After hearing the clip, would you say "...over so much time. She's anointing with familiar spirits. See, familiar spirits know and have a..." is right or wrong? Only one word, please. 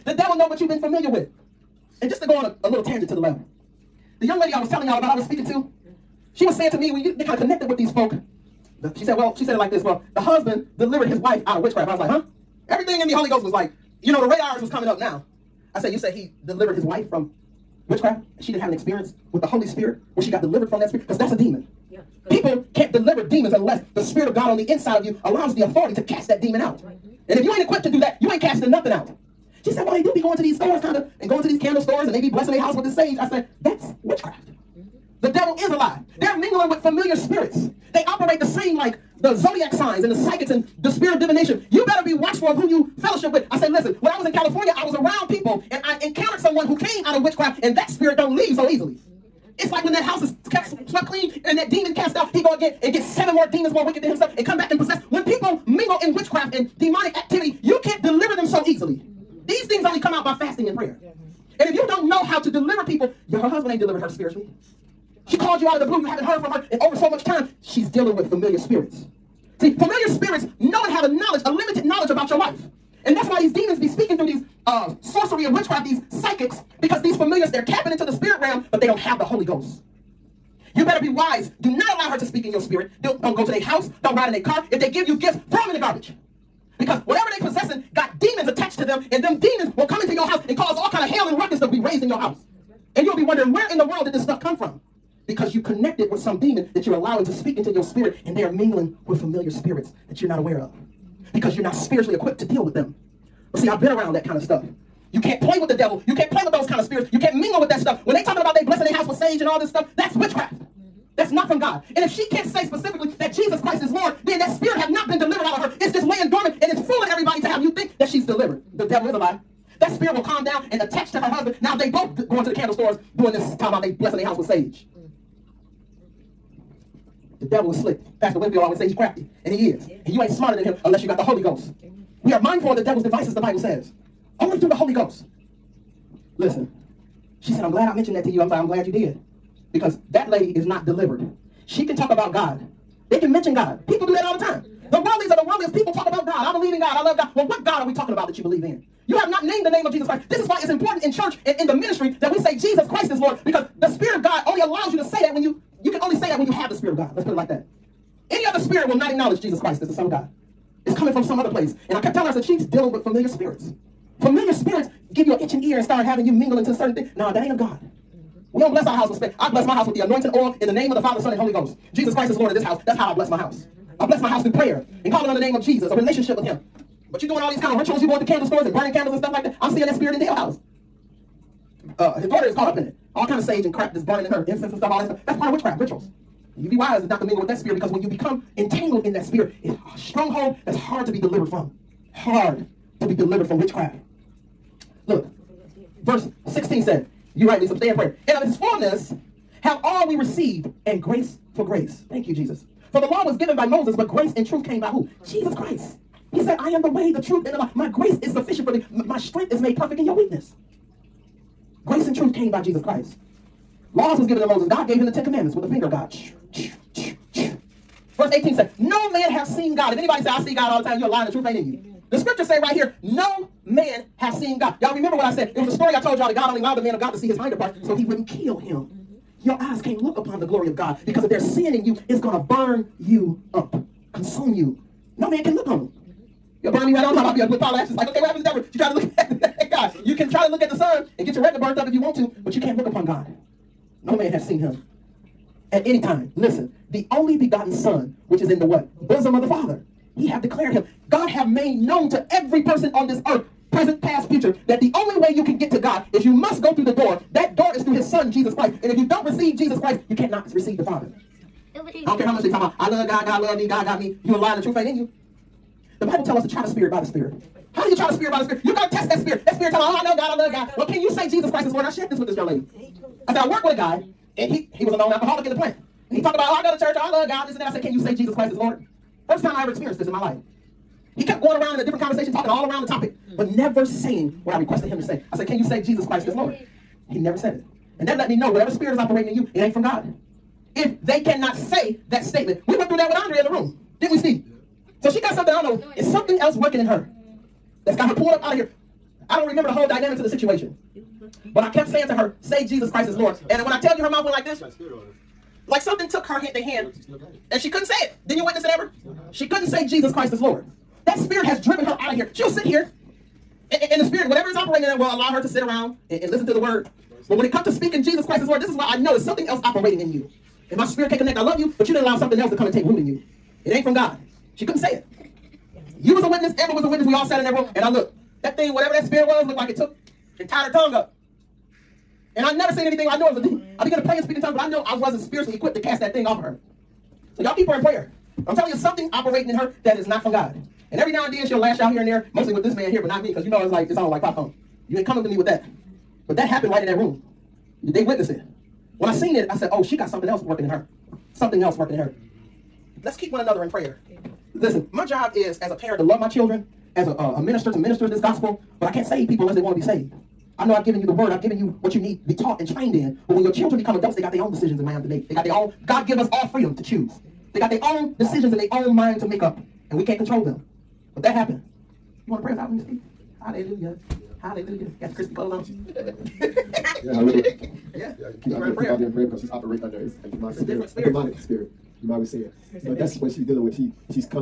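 wrong.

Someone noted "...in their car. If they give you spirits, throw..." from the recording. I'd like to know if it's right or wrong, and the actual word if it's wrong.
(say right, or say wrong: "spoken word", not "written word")
wrong: "gifts", not "spirits".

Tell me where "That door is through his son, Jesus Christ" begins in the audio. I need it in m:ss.
4:17.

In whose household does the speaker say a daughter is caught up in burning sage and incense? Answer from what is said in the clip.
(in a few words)
Dale.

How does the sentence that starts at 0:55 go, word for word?
When people mingle in witchcraft and demonic activity, you can't deliver them so easily.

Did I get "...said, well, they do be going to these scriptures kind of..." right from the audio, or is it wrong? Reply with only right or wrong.
wrong.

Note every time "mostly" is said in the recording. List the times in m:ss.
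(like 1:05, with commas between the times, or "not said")
5:42.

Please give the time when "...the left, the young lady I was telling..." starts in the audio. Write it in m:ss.
0:03.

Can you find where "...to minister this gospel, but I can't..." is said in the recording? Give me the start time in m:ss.
5:57.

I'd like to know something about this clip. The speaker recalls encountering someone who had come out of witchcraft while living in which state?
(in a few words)
California.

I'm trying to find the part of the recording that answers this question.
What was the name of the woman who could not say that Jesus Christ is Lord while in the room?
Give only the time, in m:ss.
4:53.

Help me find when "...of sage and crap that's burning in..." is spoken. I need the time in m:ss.
3:03.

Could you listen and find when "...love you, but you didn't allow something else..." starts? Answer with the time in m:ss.
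5:21.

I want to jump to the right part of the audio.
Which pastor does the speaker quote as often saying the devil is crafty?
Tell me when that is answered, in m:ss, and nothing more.
2:08.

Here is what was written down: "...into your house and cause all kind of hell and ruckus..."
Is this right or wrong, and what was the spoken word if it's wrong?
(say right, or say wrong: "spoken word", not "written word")
right.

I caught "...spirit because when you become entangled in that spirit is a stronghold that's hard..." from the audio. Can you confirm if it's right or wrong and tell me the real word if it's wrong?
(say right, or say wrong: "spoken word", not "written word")
right.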